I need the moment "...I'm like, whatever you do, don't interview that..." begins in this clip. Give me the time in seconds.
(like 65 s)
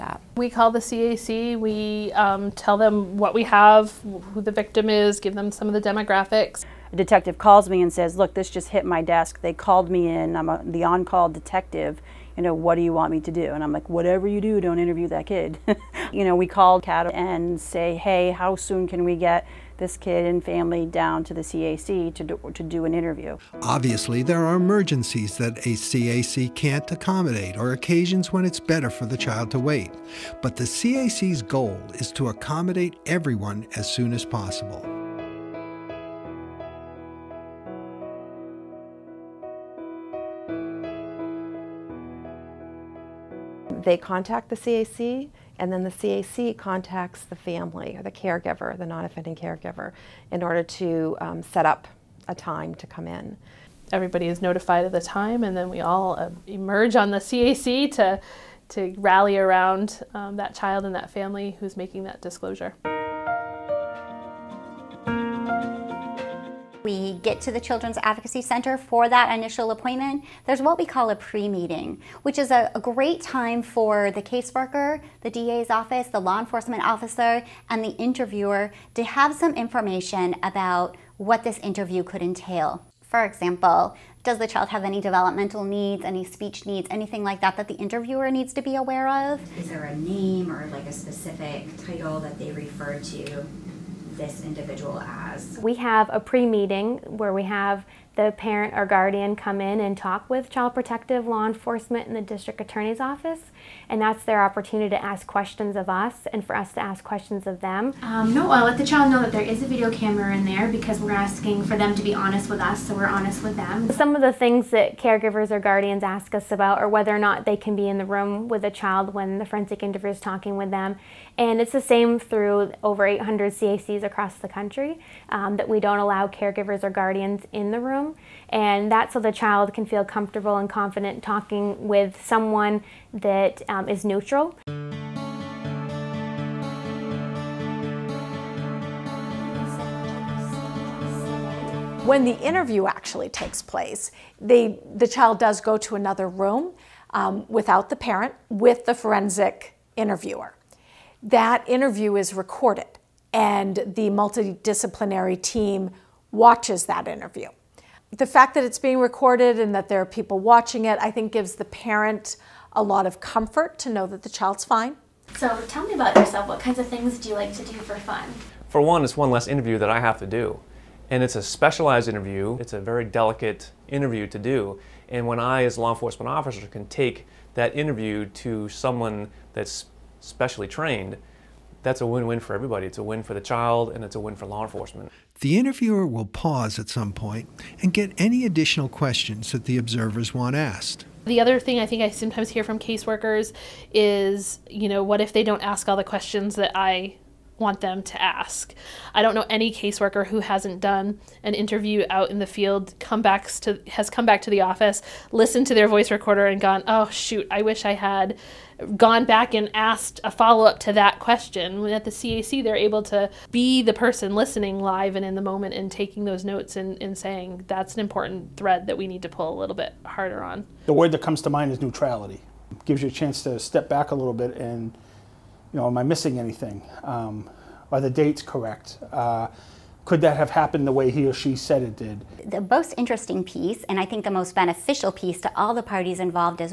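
13 s.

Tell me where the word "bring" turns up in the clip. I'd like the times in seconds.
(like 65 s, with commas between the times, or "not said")
not said.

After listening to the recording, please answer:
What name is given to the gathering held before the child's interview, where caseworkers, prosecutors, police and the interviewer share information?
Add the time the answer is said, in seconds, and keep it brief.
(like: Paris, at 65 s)
pre-meeting, at 71 s.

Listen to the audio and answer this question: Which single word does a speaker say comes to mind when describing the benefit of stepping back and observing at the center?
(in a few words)
neutrality.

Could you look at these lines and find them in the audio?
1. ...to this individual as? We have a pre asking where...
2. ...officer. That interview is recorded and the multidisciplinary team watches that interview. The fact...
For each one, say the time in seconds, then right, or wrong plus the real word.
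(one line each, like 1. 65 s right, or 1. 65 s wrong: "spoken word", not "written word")
1. 92 s wrong: "meeting", not "asking"
2. 149 s wrong: "interviewer", not "officer".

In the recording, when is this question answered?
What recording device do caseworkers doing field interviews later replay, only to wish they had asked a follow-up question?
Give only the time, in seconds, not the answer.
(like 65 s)
205 s.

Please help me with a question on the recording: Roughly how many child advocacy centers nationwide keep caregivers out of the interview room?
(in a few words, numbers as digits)
over 800.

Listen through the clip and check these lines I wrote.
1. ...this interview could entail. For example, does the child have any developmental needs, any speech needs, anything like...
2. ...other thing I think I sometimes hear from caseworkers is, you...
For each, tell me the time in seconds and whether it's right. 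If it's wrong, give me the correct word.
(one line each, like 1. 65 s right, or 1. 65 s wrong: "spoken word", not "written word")
1. 81 s right
2. 191 s right.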